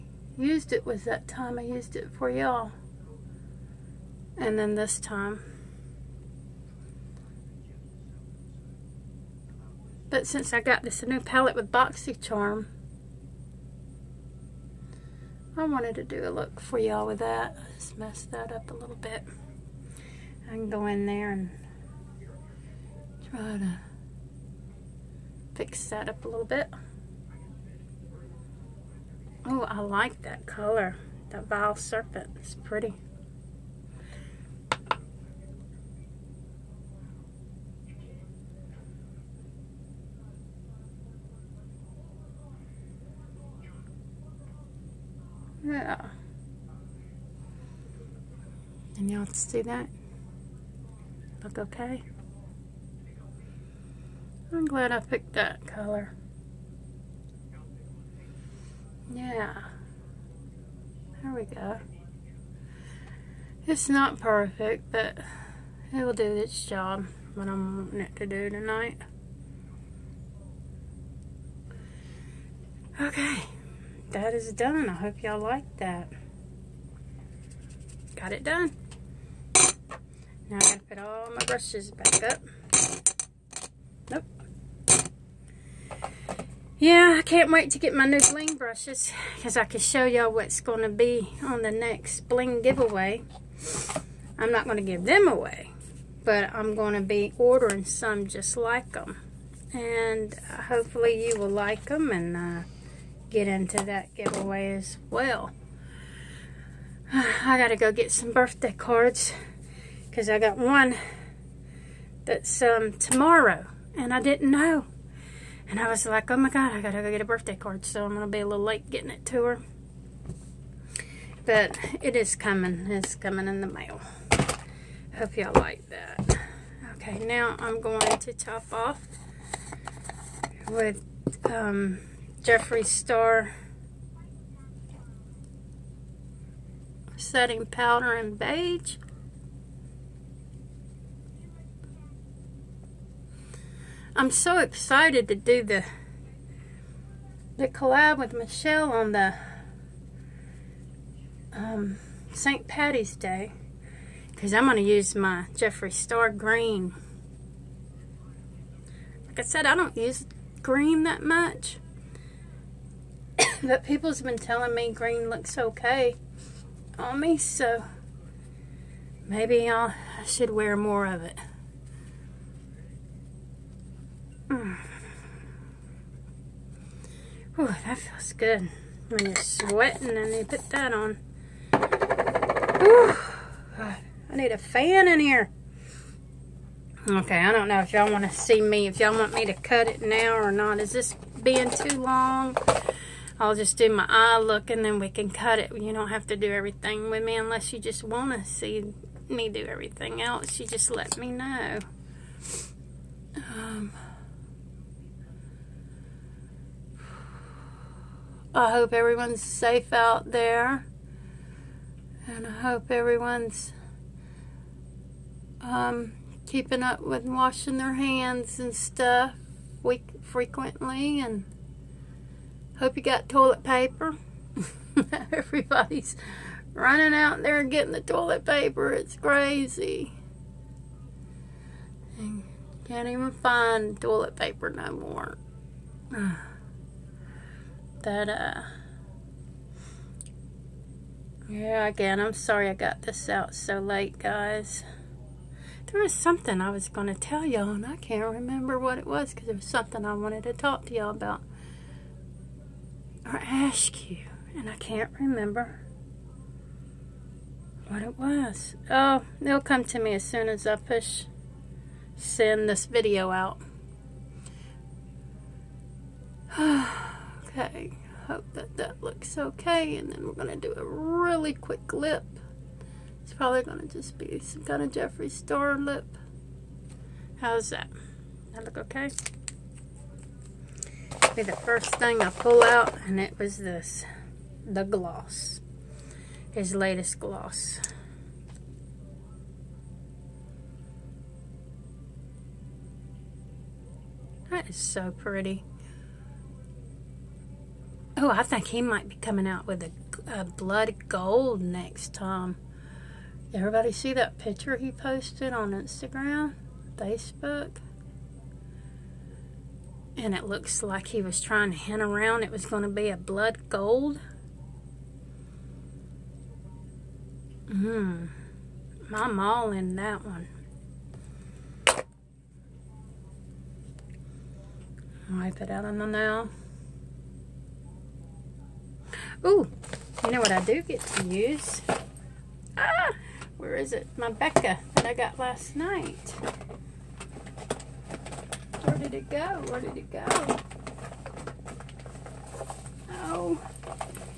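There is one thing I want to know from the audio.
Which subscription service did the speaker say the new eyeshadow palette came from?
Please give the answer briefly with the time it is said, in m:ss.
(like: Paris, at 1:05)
Boxycharm, at 0:11.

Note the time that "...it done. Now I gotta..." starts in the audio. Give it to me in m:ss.
1:18.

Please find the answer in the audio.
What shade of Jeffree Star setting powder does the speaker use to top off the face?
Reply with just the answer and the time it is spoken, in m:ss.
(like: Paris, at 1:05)
Beige, at 2:18.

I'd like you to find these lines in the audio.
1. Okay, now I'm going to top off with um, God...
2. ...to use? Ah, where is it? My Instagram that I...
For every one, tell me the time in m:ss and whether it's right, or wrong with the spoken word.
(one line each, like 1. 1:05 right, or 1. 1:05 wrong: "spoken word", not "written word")
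1. 2:06 wrong: "Jeffree", not "God"
2. 5:31 wrong: "Becca", not "Instagram".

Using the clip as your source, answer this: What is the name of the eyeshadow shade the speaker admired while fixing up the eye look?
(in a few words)
Vile Serpent.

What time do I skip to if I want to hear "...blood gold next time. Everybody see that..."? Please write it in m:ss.
5:00.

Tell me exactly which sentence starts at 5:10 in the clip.
and it looks like he was trying to hint around it was going to be a blood gold.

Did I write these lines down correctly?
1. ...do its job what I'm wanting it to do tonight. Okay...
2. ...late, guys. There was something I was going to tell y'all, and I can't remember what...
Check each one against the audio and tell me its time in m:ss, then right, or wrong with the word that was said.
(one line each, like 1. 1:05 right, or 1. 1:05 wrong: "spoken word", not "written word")
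1. 1:06 right
2. 4:03 right.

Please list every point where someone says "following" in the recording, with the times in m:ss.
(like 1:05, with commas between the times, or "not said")
not said.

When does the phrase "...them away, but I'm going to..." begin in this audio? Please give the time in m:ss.
1:35.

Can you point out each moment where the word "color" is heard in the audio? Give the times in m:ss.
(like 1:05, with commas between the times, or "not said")
0:30, 0:55.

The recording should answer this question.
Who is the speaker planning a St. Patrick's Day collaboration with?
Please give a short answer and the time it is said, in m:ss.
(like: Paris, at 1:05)
Michelle, at 2:28.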